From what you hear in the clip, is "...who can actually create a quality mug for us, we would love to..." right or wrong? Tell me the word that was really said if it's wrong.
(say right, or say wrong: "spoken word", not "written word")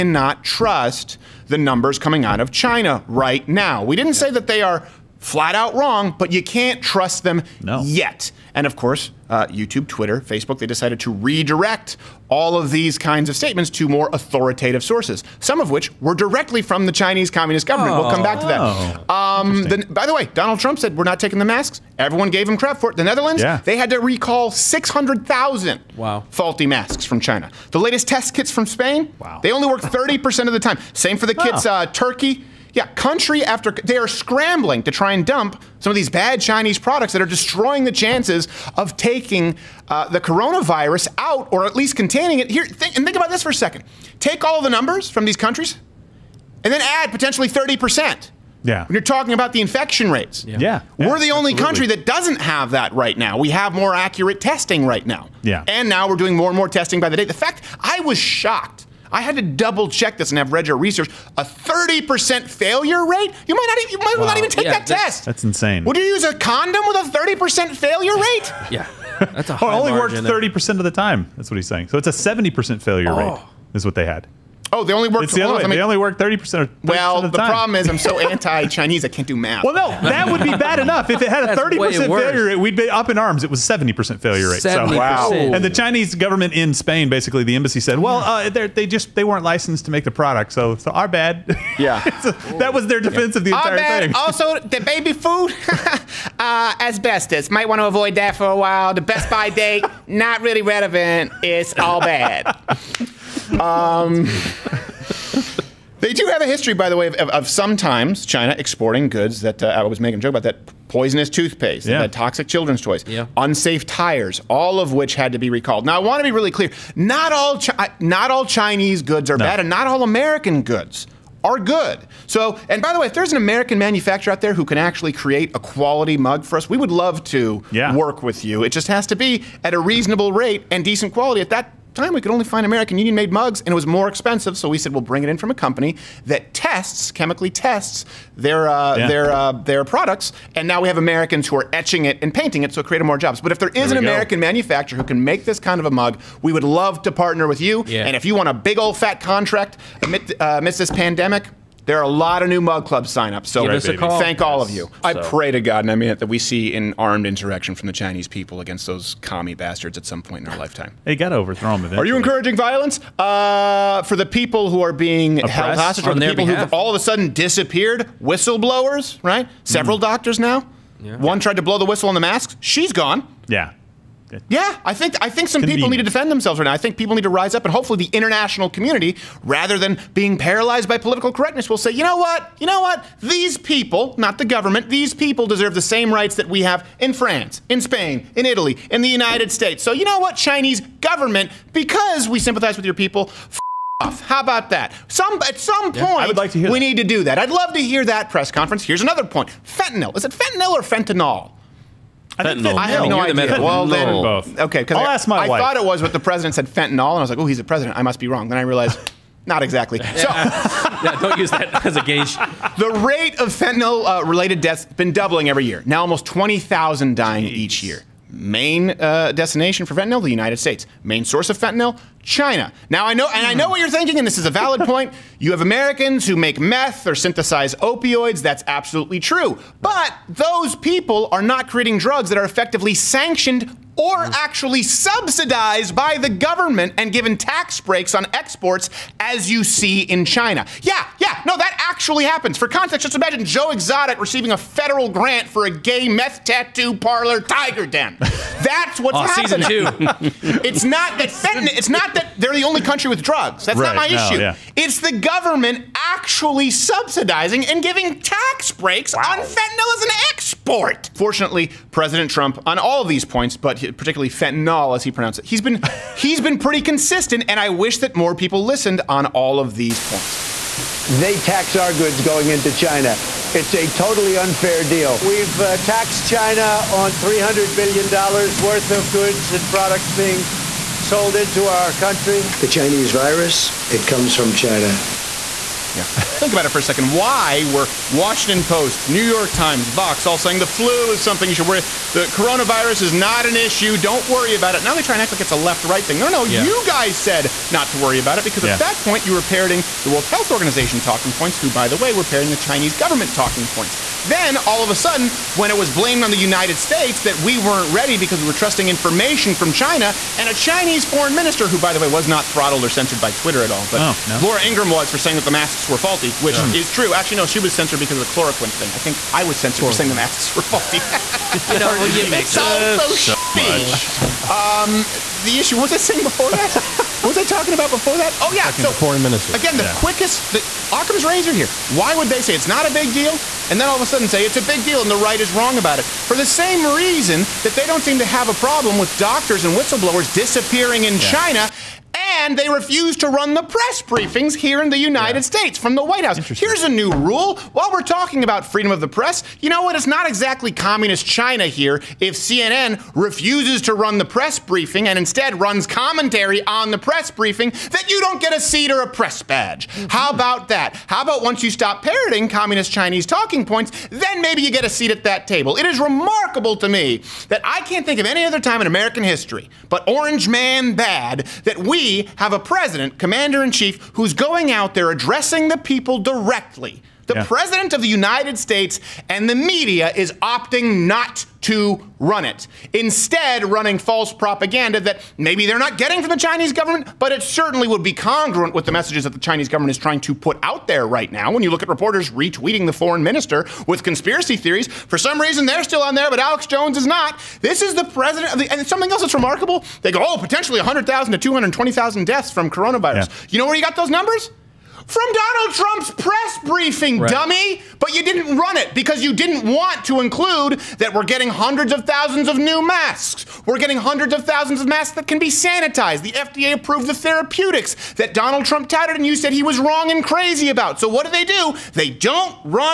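right.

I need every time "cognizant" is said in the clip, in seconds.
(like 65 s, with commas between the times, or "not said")
not said.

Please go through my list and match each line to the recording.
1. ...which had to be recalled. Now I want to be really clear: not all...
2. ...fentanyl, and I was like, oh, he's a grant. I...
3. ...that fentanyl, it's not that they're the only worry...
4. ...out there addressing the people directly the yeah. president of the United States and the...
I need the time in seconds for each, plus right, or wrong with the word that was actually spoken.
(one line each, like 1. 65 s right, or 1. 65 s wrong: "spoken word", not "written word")
1. 114 s right
2. 206 s wrong: "president", not "grant"
3. 251 s wrong: "country", not "worry"
4. 374 s right.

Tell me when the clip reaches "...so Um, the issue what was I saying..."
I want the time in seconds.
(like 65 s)
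323 s.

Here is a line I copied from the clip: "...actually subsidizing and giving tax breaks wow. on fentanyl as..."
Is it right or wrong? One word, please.
right.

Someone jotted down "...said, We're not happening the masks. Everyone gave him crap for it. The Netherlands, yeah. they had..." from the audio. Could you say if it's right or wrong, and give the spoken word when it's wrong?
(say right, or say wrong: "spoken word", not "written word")
wrong: "taking", not "happening".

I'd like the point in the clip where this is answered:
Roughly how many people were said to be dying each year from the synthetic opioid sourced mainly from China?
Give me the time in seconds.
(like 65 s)
216 s.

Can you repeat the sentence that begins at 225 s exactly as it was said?
You have Americans who make meth or synthesize opioids.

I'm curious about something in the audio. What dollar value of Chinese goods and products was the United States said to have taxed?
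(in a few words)
$300 billion.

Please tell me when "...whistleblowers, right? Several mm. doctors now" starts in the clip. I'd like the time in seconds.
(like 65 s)
168 s.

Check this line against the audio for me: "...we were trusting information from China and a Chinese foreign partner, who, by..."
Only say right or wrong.
wrong.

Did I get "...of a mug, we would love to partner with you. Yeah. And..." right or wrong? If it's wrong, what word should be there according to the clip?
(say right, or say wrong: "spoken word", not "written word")
right.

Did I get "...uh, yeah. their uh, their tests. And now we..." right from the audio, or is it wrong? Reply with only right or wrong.
wrong.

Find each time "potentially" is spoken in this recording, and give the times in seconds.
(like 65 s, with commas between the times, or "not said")
47 s, 400 s.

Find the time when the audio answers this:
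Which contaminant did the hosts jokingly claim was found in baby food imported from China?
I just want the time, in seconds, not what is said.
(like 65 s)
96 s.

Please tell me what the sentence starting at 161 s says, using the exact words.
they got to overthrow them eventually.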